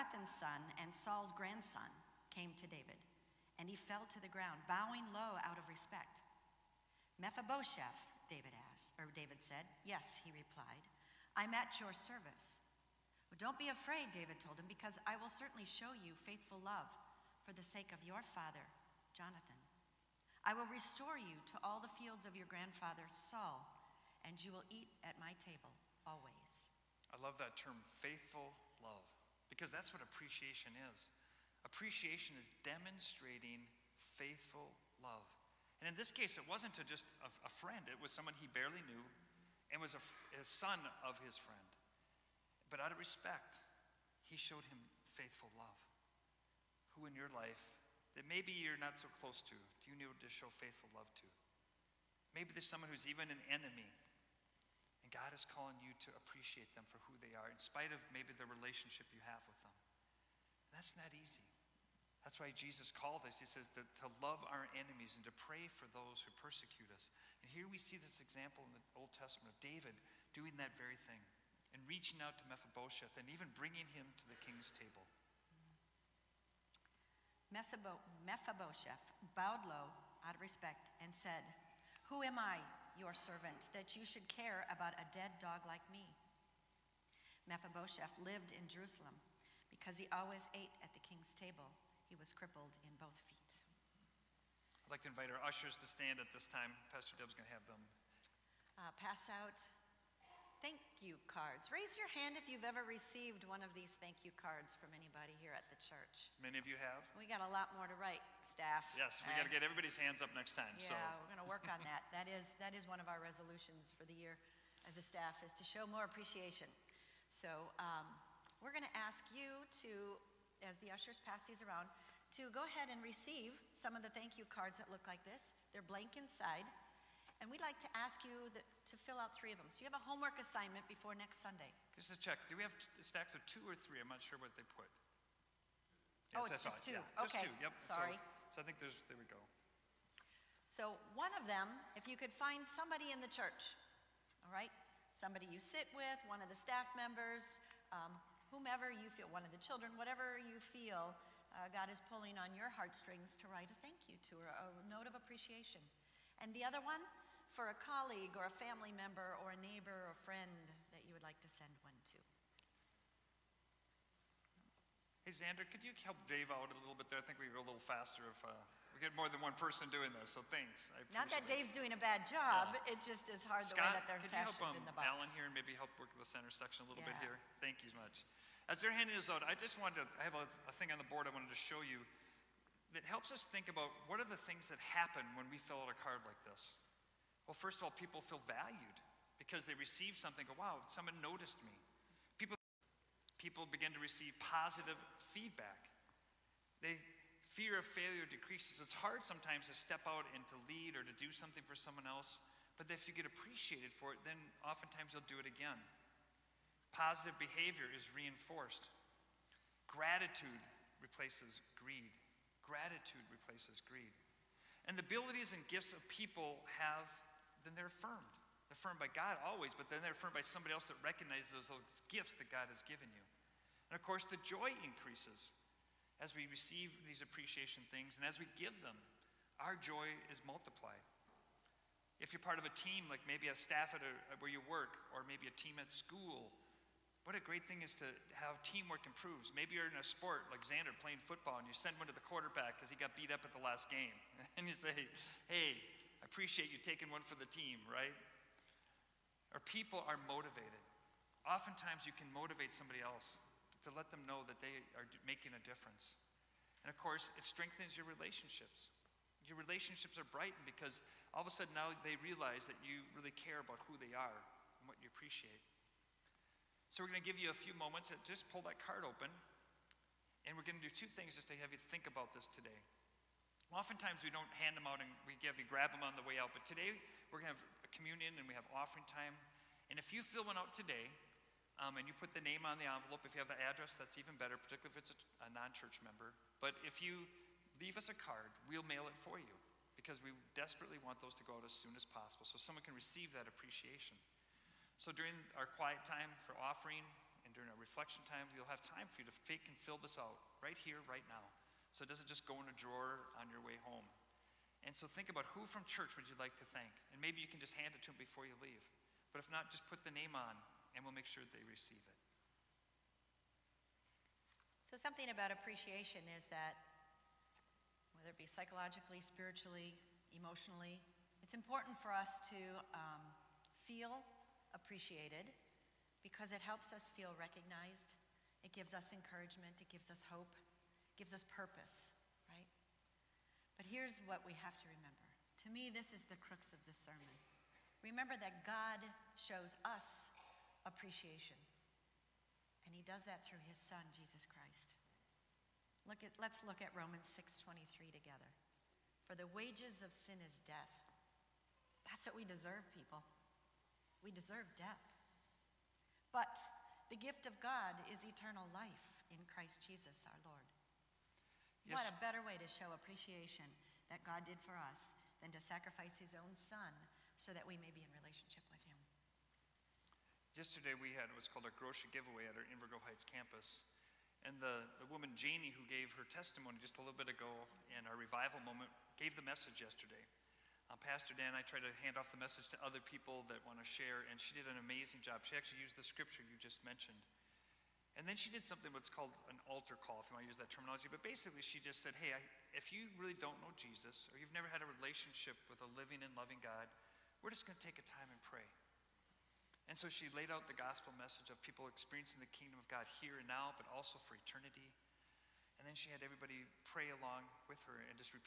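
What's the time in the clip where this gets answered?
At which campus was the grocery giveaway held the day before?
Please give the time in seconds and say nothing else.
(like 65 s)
372 s.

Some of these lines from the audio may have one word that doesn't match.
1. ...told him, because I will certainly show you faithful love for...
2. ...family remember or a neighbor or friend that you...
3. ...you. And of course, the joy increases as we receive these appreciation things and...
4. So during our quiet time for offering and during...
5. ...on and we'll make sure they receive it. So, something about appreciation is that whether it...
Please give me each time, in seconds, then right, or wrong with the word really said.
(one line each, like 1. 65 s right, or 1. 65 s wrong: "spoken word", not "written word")
1. 14 s right
2. 158 s wrong: "member", not "remember"
3. 223 s right
4. 295 s right
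5. 310 s right.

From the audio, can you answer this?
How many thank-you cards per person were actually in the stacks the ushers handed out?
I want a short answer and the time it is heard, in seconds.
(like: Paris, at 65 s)
2, at 136 s.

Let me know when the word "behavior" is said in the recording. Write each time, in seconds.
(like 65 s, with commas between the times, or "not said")
207 s.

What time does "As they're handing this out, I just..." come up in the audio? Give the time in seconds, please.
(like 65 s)
178 s.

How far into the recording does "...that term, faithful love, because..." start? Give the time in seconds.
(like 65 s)
27 s.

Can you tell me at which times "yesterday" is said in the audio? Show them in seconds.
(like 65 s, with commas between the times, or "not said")
370 s, 379 s.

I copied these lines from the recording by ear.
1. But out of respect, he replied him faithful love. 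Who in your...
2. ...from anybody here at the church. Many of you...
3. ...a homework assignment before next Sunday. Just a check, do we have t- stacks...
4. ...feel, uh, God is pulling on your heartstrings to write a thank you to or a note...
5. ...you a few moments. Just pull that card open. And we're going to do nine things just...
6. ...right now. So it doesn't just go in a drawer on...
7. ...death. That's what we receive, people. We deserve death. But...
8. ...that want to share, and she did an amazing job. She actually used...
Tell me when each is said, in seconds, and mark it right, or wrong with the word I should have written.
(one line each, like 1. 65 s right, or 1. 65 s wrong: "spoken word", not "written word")
1. 42 s wrong: "showed", not "replied"
2. 104 s right
3. 129 s right
4. 150 s right
5. 267 s wrong: "two", not "nine"
6. 301 s right
7. 350 s wrong: "deserve", not "receive"
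8. 383 s right.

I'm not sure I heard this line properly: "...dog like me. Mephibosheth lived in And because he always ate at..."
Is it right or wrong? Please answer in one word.
wrong.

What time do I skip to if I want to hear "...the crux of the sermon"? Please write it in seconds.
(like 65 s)
336 s.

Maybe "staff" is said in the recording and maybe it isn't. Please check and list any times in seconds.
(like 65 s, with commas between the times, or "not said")
108 s, 115 s, 146 s, 233 s.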